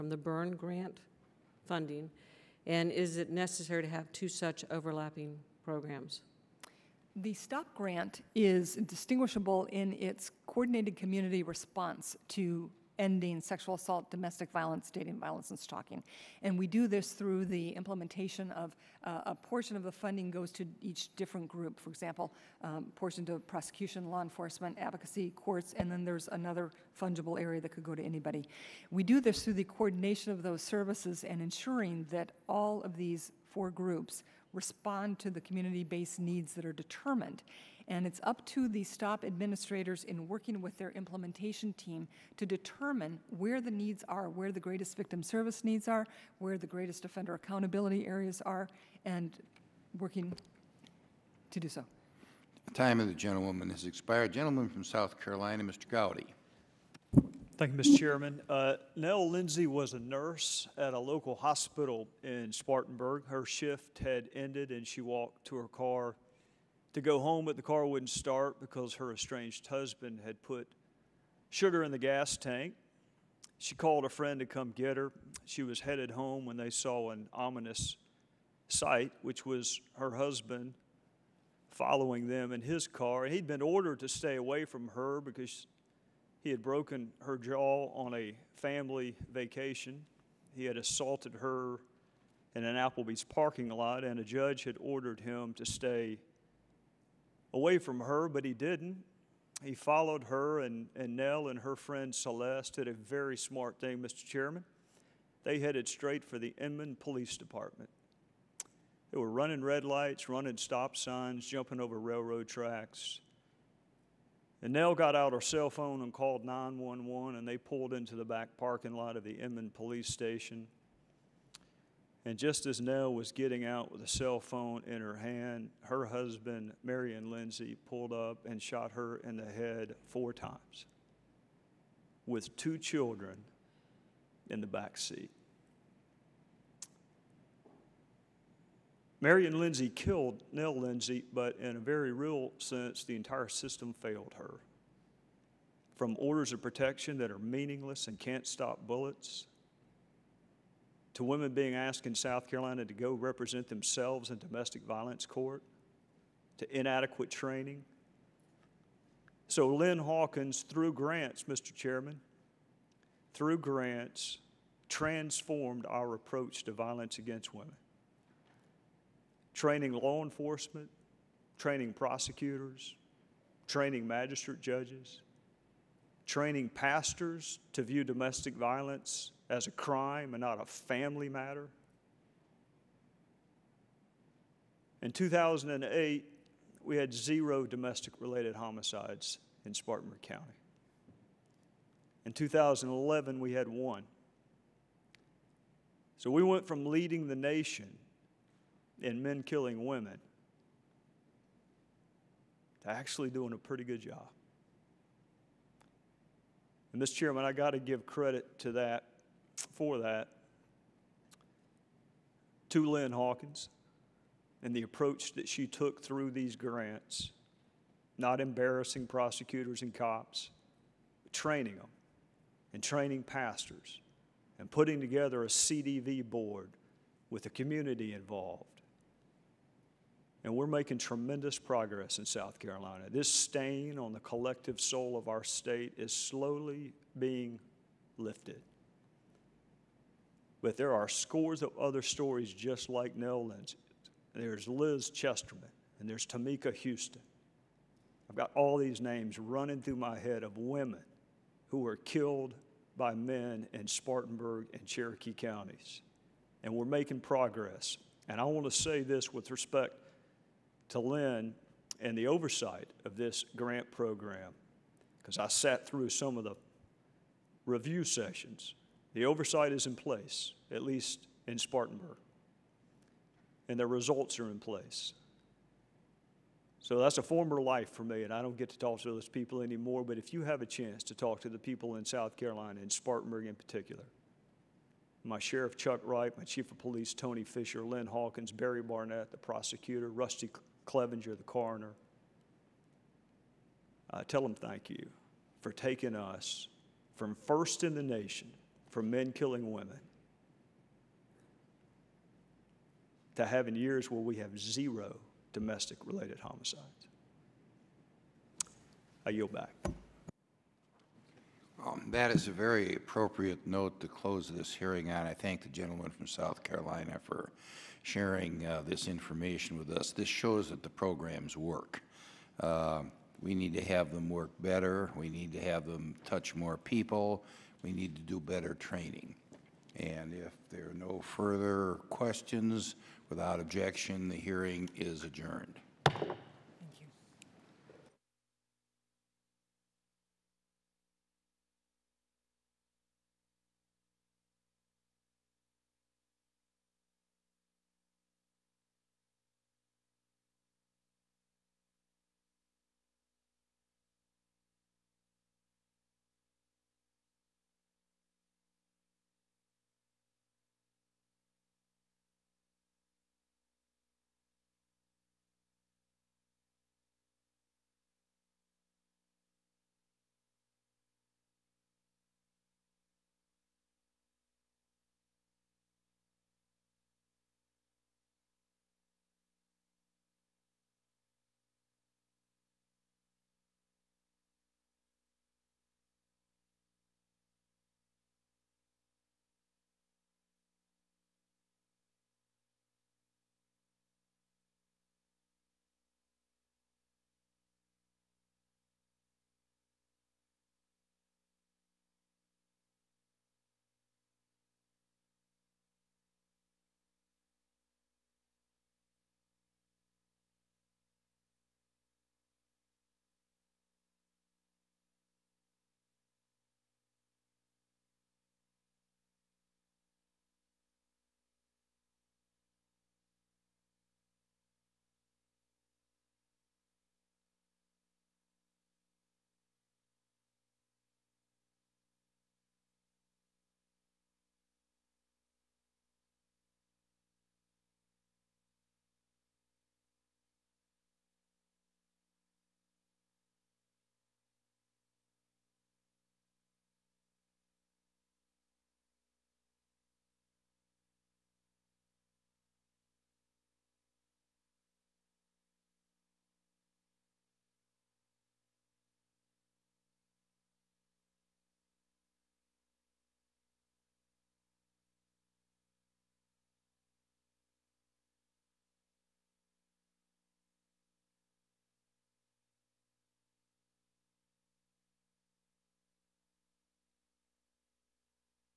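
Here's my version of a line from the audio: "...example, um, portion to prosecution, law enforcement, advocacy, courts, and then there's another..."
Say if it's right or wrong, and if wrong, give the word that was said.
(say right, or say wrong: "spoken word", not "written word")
right.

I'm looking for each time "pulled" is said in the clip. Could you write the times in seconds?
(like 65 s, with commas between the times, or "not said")
117 s, 127 s.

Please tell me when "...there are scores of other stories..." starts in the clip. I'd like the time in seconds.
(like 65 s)
240 s.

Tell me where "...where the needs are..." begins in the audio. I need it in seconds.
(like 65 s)
43 s.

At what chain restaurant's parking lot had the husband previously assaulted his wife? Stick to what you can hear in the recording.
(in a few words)
Applebee's.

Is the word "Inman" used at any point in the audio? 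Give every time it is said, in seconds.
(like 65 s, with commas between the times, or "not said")
106 s, 119 s.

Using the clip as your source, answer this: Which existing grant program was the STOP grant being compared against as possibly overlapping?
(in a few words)
Byrne grant.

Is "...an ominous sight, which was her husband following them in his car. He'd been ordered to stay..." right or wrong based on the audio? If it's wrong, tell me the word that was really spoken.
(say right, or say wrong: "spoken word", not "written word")
right.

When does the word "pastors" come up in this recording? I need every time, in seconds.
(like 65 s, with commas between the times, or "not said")
176 s, 223 s.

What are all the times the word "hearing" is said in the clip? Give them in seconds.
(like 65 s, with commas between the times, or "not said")
314 s, 334 s.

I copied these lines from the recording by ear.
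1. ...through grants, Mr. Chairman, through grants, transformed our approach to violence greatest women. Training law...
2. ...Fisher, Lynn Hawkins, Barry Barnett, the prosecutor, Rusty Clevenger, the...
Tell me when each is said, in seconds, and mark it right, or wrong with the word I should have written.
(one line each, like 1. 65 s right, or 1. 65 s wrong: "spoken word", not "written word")
1. 160 s wrong: "against", not "greatest"
2. 287 s right.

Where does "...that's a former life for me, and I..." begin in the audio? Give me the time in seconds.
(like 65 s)
276 s.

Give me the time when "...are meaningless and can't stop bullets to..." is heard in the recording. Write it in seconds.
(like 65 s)
147 s.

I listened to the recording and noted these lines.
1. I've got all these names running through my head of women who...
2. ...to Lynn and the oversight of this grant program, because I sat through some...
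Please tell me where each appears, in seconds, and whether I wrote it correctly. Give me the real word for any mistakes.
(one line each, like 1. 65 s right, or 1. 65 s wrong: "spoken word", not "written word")
1. 248 s right
2. 260 s right.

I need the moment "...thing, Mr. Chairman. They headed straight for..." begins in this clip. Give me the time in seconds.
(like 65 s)
103 s.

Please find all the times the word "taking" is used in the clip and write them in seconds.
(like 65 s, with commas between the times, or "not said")
295 s.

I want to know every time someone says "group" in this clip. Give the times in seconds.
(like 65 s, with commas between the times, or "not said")
21 s, 33 s.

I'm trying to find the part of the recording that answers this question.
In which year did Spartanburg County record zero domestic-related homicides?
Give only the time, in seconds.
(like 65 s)
185 s.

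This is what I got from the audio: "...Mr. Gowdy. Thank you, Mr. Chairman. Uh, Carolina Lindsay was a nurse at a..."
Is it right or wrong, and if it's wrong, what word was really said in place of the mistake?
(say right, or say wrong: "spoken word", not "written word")
wrong: "Nell", not "Carolina".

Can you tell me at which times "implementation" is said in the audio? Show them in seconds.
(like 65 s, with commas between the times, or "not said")
17 s, 40 s.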